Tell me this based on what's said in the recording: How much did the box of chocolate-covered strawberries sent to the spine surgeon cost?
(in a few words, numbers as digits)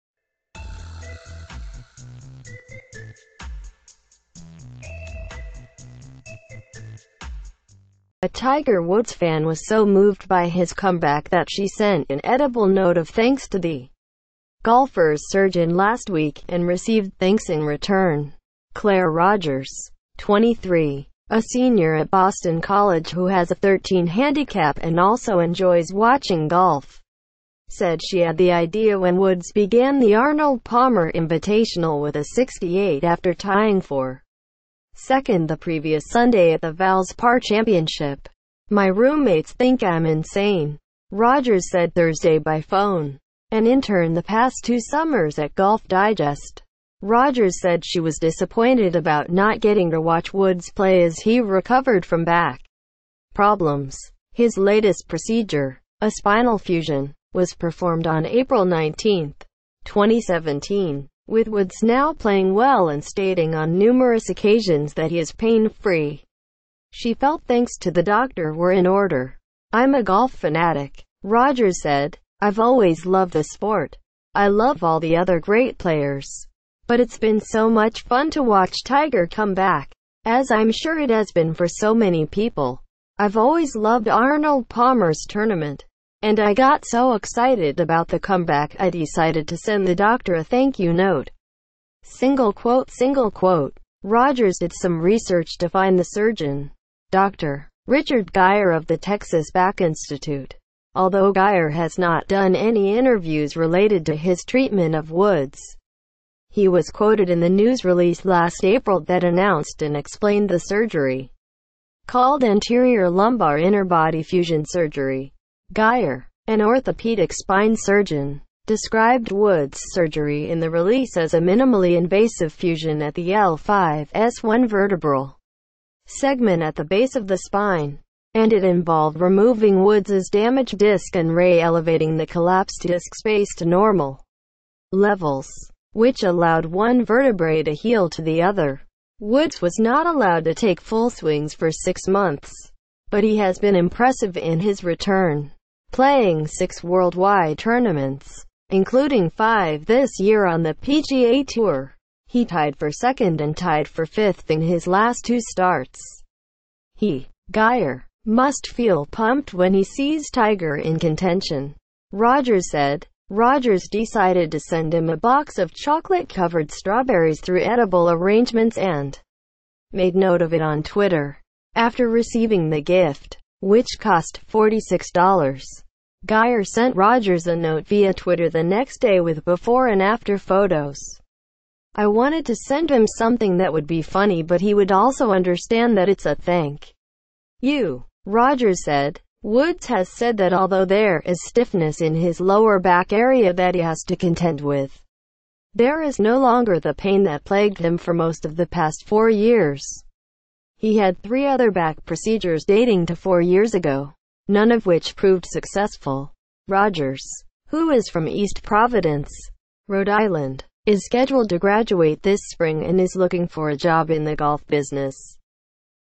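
$46.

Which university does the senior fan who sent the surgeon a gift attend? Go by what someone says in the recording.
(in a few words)
Boston College.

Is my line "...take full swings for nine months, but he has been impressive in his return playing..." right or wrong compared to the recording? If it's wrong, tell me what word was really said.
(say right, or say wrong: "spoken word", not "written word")
wrong: "six", not "nine".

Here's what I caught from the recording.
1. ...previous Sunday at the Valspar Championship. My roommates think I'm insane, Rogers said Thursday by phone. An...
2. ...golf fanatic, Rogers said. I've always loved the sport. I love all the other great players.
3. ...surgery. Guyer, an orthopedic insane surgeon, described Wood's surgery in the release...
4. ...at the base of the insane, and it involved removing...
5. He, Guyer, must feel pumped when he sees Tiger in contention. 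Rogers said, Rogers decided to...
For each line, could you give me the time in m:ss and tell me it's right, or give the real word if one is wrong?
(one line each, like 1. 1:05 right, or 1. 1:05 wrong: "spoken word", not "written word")
1. 0:35 right
2. 1:10 right
3. 1:54 wrong: "spine", not "insane"
4. 2:06 wrong: "spine", not "insane"
5. 2:36 right.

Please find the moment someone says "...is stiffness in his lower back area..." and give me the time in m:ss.
3:11.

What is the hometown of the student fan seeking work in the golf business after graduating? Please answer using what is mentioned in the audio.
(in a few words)
East Providence, Rhode Island.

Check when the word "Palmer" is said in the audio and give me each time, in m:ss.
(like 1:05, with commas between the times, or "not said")
0:30, 1:24.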